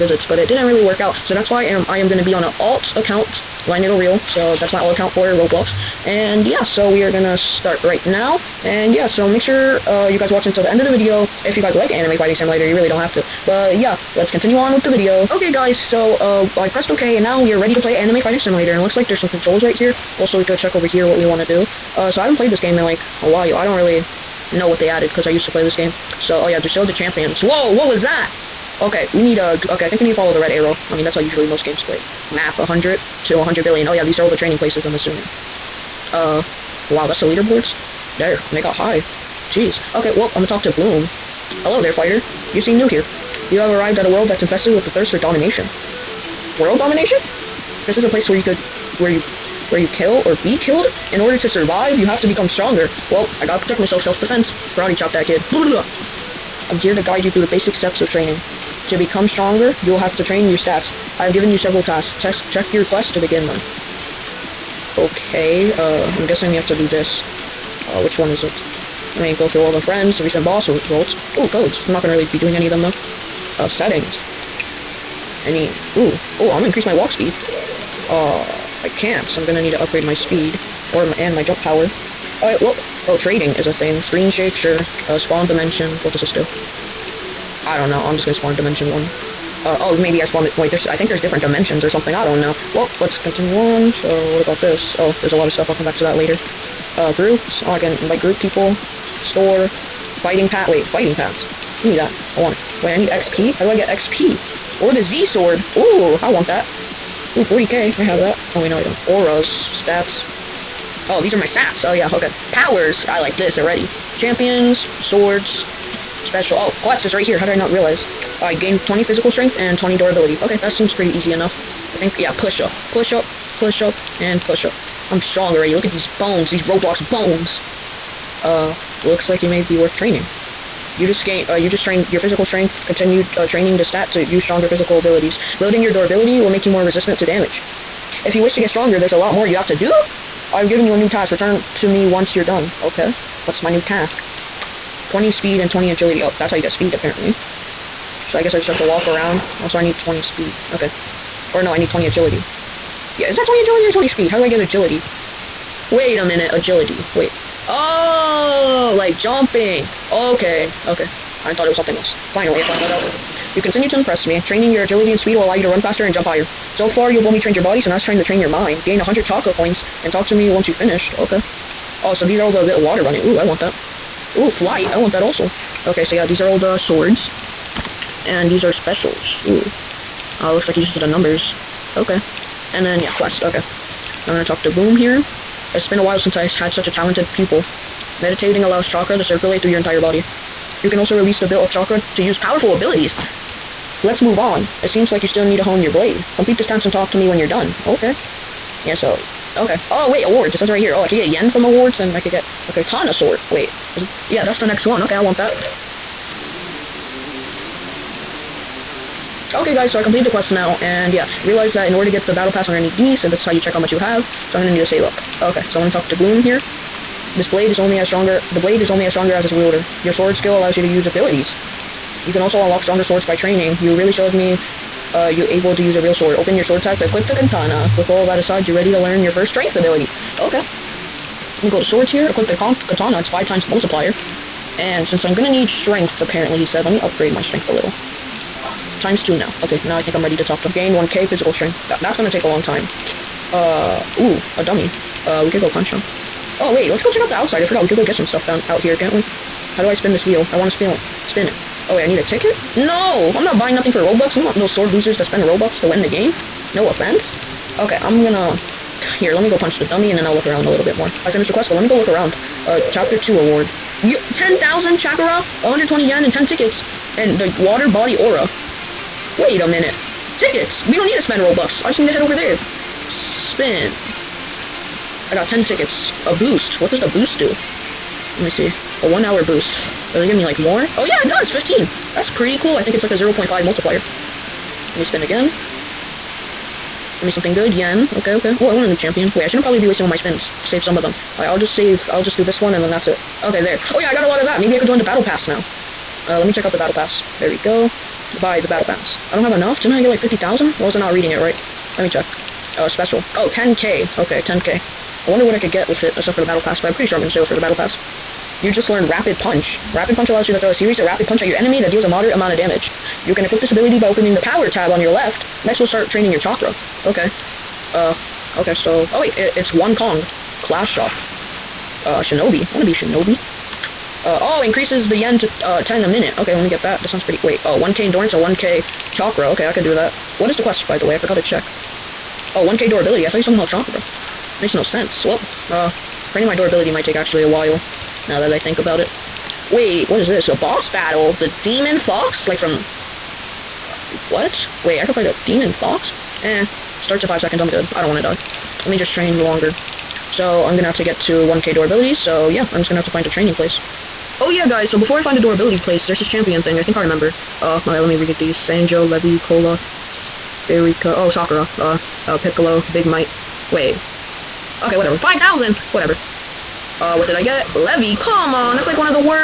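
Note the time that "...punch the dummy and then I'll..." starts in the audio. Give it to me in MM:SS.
04:19.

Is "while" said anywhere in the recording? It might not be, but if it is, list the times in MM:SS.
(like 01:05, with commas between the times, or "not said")
00:23, 03:06, 05:37.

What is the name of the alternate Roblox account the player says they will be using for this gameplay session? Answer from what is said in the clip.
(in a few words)
Line Needle Reel.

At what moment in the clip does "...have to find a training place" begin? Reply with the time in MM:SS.
05:52.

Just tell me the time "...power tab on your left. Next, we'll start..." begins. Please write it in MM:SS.
05:14.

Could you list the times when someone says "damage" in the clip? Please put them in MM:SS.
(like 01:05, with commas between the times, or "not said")
02:17, 05:12.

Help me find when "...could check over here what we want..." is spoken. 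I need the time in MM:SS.
00:20.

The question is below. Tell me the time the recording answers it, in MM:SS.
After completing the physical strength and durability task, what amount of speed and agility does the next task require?
02:25.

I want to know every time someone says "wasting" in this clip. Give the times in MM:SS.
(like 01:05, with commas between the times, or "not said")
04:49.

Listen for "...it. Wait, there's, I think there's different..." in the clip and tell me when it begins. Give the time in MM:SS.
01:30.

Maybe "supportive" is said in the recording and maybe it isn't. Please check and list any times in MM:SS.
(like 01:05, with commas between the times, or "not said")
not said.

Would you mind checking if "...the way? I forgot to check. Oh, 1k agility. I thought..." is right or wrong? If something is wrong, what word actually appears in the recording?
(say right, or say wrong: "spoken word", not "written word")
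wrong: "durability", not "agility".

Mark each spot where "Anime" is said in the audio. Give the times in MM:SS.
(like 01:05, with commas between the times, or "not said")
00:11, 00:17.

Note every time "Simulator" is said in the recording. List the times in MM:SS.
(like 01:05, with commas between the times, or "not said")
00:12, 00:18.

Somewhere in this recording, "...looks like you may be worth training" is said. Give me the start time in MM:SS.
02:09.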